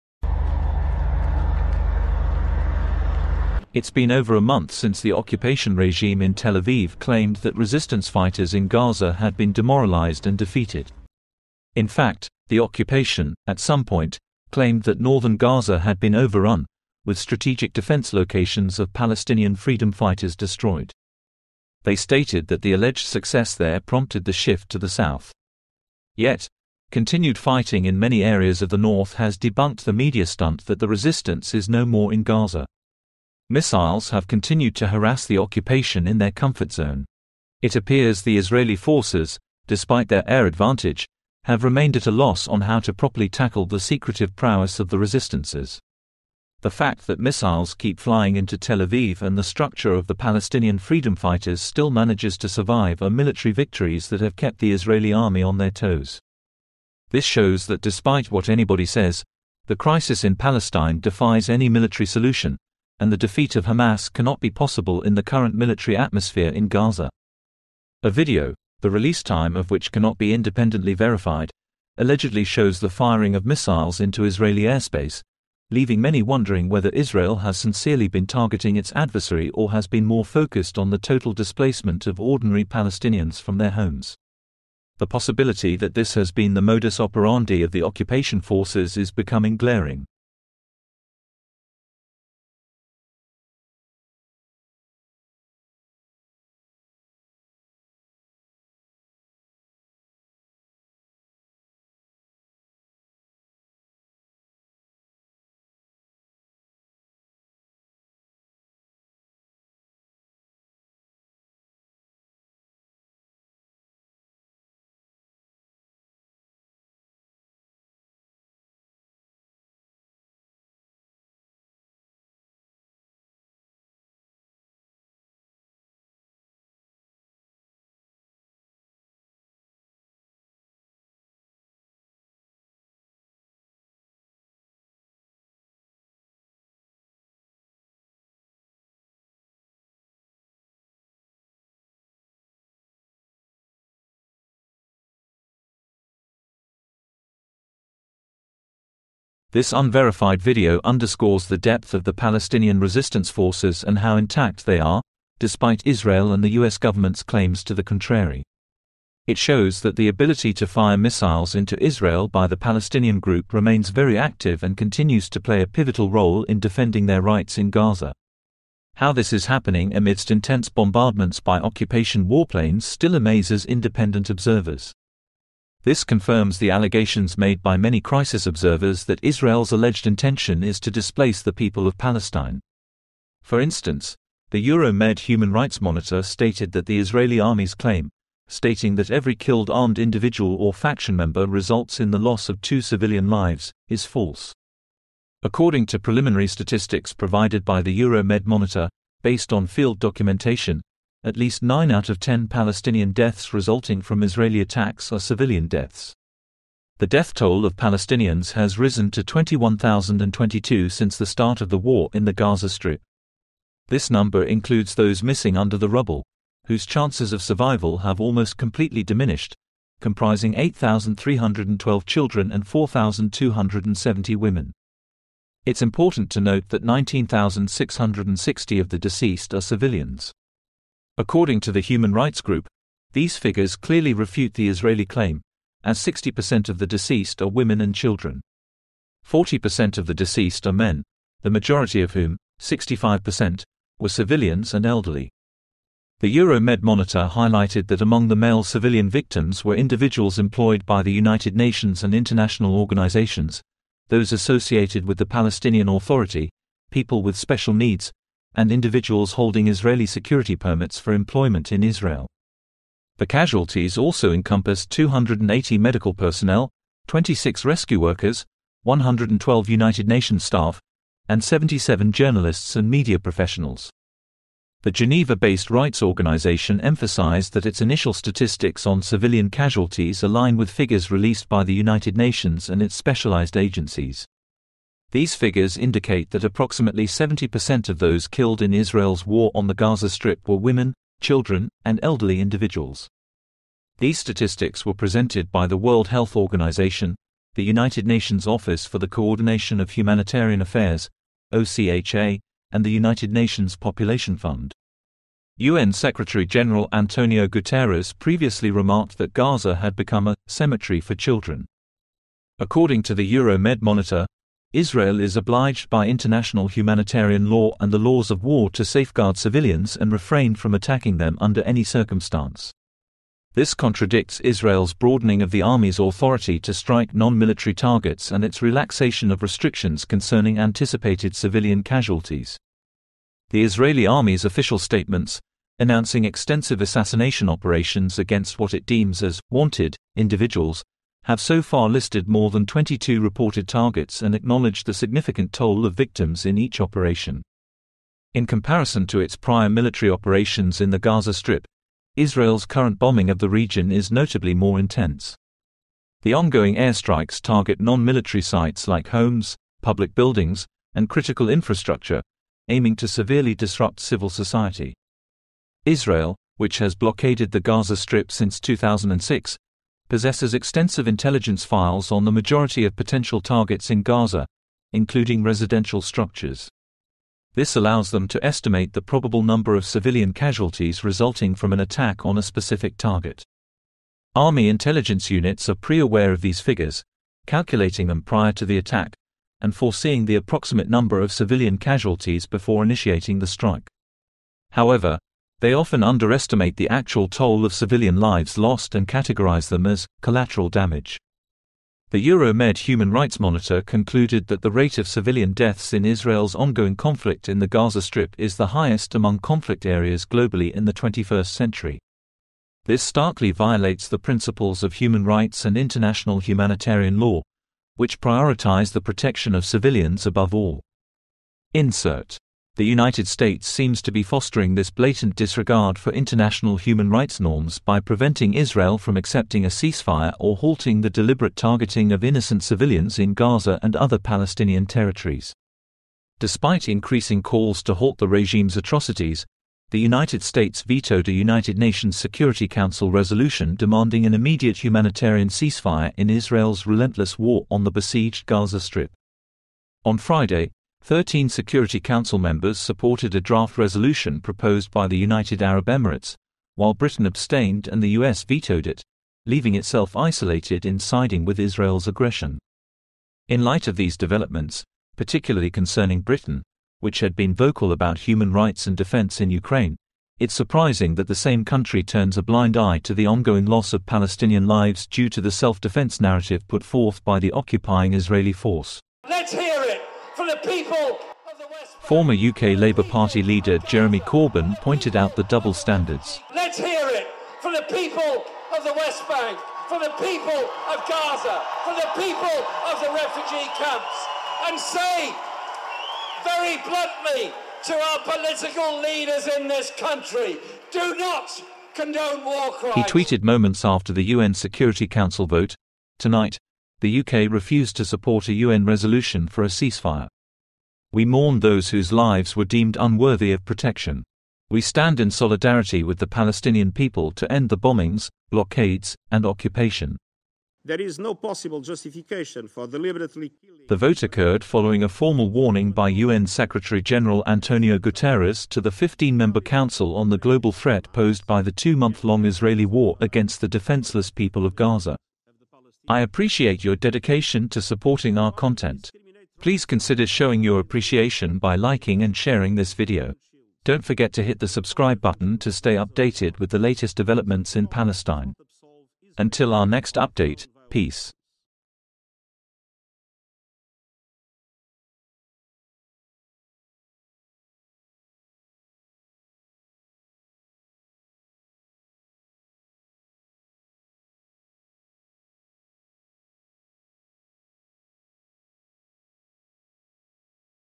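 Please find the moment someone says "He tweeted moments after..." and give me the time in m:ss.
8:22.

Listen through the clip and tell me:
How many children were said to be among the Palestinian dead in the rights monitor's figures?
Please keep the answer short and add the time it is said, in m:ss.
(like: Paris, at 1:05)
8,312, at 3:40.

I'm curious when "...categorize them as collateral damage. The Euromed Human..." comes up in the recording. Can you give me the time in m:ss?
6:39.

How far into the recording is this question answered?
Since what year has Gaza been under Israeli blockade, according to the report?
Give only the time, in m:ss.
6:08.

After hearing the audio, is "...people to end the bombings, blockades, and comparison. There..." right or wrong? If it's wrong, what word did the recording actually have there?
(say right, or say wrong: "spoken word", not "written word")
wrong: "occupation", not "comparison".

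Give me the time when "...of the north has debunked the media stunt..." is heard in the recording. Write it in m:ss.
0:28.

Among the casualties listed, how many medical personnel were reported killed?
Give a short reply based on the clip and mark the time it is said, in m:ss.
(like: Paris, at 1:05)
280, at 4:24.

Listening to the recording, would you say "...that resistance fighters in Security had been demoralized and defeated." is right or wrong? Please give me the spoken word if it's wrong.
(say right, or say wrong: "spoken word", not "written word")
wrong: "Gaza", not "Security".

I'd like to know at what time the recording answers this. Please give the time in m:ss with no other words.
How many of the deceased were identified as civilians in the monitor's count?
3:46.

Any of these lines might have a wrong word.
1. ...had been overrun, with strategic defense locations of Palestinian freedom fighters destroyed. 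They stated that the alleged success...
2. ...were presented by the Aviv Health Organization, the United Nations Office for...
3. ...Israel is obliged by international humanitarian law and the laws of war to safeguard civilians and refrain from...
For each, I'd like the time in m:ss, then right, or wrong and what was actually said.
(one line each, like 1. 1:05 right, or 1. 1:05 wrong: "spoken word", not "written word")
1. 0:15 right
2. 4:54 wrong: "World", not "Aviv"
3. 5:14 right.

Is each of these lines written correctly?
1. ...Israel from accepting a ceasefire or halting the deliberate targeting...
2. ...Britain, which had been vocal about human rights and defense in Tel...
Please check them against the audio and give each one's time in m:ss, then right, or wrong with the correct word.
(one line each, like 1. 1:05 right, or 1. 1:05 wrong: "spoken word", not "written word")
1. 7:08 right
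2. 7:46 wrong: "Ukraine", not "Tel".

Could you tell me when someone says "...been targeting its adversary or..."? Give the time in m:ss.
1:18.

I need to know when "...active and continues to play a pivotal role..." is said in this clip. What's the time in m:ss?
2:44.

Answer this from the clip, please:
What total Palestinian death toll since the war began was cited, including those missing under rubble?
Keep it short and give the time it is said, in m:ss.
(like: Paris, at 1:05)
21,022, at 3:29.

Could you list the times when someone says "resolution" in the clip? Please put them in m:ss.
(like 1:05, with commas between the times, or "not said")
7:23, 7:33, 8:28.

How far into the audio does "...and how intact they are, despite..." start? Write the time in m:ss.
2:33.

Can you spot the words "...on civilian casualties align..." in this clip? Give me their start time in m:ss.
4:38.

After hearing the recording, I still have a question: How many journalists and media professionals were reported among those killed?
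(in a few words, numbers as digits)
77.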